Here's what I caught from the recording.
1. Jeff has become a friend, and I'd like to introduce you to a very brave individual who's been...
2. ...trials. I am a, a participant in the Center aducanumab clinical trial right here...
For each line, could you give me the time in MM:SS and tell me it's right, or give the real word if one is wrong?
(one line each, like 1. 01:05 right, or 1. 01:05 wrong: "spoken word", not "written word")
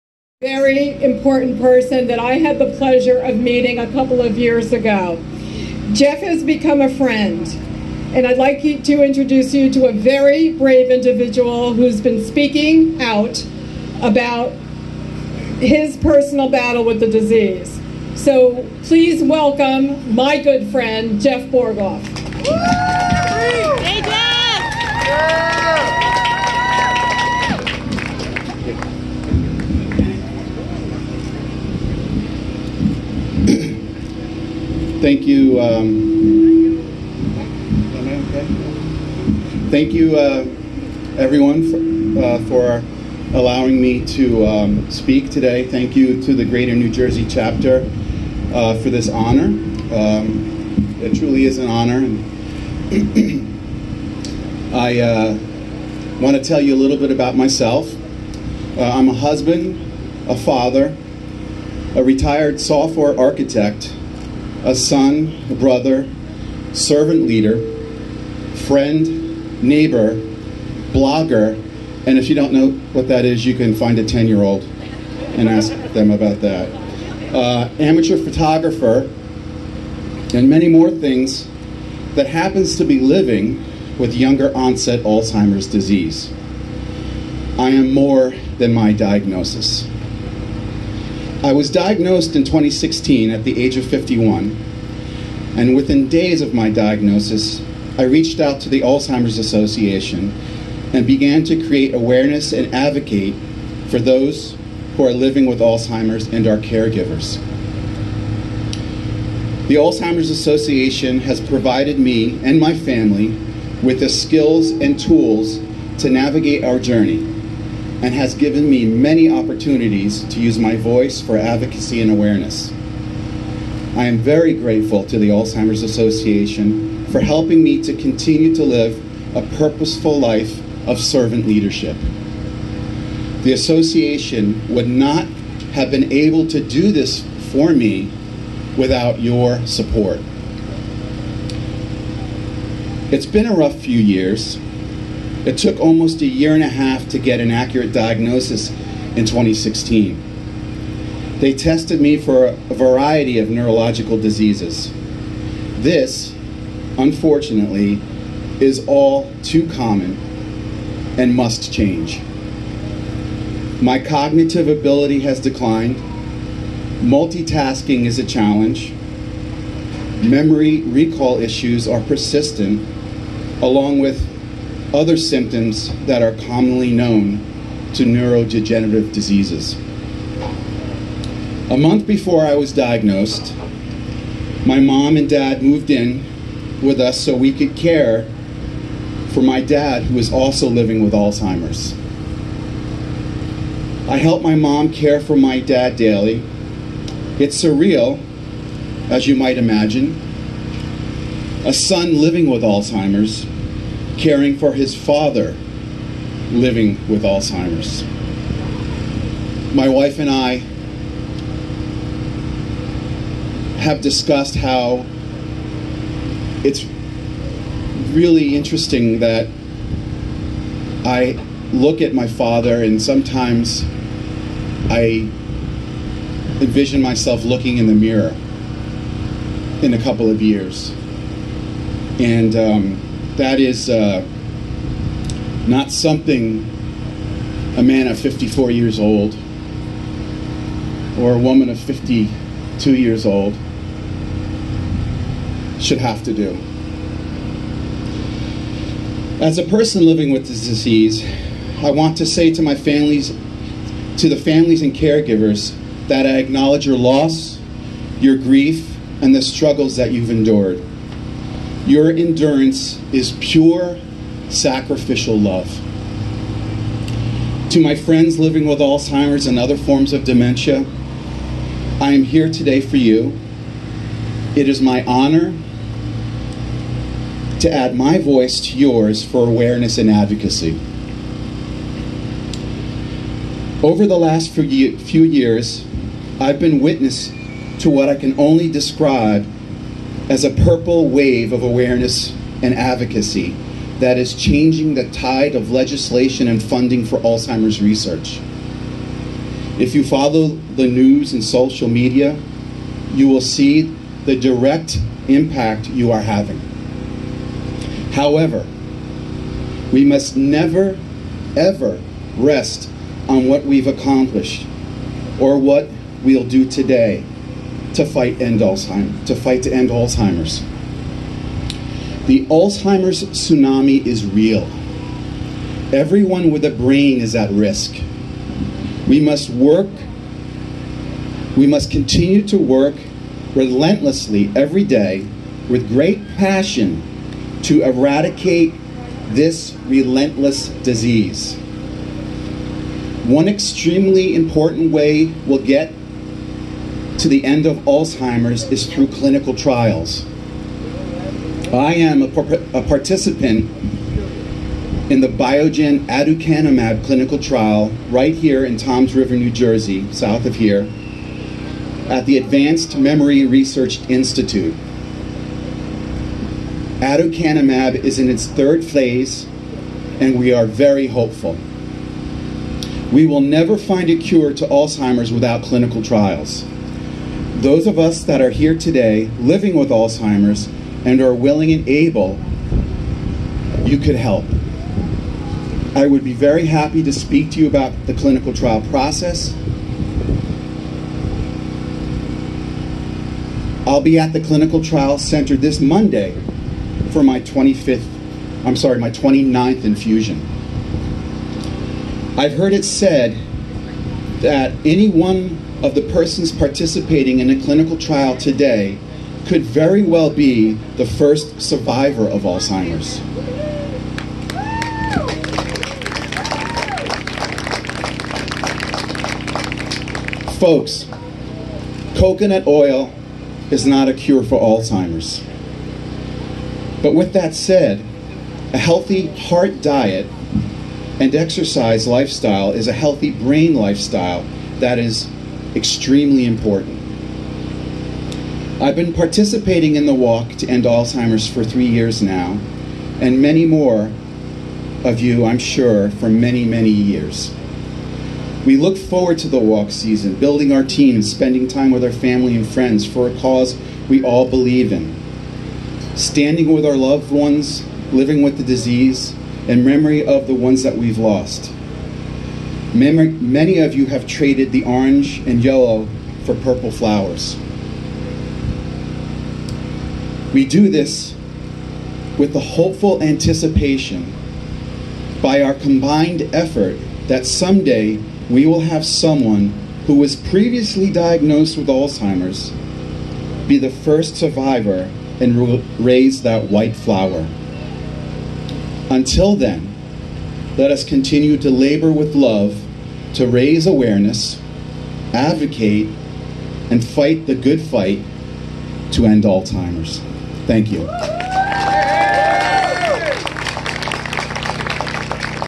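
1. 00:05 right
2. 05:49 wrong: "Biogen", not "Center".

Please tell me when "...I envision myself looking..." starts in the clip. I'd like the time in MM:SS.
03:44.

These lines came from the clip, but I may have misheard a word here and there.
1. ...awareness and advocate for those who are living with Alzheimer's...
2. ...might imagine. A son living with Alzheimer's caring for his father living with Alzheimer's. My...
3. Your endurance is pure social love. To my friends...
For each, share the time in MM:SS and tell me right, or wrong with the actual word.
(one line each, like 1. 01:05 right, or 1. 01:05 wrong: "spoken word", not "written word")
1. 01:41 right
2. 03:19 right
3. 04:21 wrong: "sacrificial", not "social".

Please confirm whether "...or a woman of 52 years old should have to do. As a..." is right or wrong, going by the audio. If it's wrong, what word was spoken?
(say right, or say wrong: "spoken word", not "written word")
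right.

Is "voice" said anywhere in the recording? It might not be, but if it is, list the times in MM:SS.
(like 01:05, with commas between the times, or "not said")
02:00, 04:38.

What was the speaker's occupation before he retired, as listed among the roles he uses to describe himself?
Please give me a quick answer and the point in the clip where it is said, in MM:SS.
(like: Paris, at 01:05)
Software architect, at 01:02.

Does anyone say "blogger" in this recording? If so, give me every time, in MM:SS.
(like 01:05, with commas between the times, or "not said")
01:10.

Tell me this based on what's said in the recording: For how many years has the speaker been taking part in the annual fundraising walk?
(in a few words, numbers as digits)
3 years.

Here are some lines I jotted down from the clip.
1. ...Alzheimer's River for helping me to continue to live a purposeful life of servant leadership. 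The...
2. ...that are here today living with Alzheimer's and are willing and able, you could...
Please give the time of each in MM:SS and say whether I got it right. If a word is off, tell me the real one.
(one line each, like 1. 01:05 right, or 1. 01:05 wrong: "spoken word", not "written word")
1. 02:05 wrong: "Association", not "River"
2. 06:18 right.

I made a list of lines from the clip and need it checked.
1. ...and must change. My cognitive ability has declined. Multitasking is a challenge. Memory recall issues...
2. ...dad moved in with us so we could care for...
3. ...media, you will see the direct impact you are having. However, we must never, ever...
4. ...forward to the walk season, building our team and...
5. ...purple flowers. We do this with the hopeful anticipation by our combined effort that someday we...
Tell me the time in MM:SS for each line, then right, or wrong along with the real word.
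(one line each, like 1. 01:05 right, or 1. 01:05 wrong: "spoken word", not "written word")
1. 02:41 right
2. 03:05 right
3. 05:01 right
4. 07:28 right
5. 07:46 right.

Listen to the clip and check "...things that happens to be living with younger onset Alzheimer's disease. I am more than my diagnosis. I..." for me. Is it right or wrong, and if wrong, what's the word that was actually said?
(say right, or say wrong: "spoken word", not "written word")
right.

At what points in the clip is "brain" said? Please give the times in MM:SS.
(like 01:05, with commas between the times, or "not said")
05:26, 07:13.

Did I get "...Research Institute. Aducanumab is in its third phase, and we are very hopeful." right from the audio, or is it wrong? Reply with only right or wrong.
right.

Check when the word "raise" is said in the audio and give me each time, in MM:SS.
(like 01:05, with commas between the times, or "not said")
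08:06, 08:13.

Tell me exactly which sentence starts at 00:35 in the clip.
Um, thank you, uh, everyone, for, uh, for, allowing me to um, speak today.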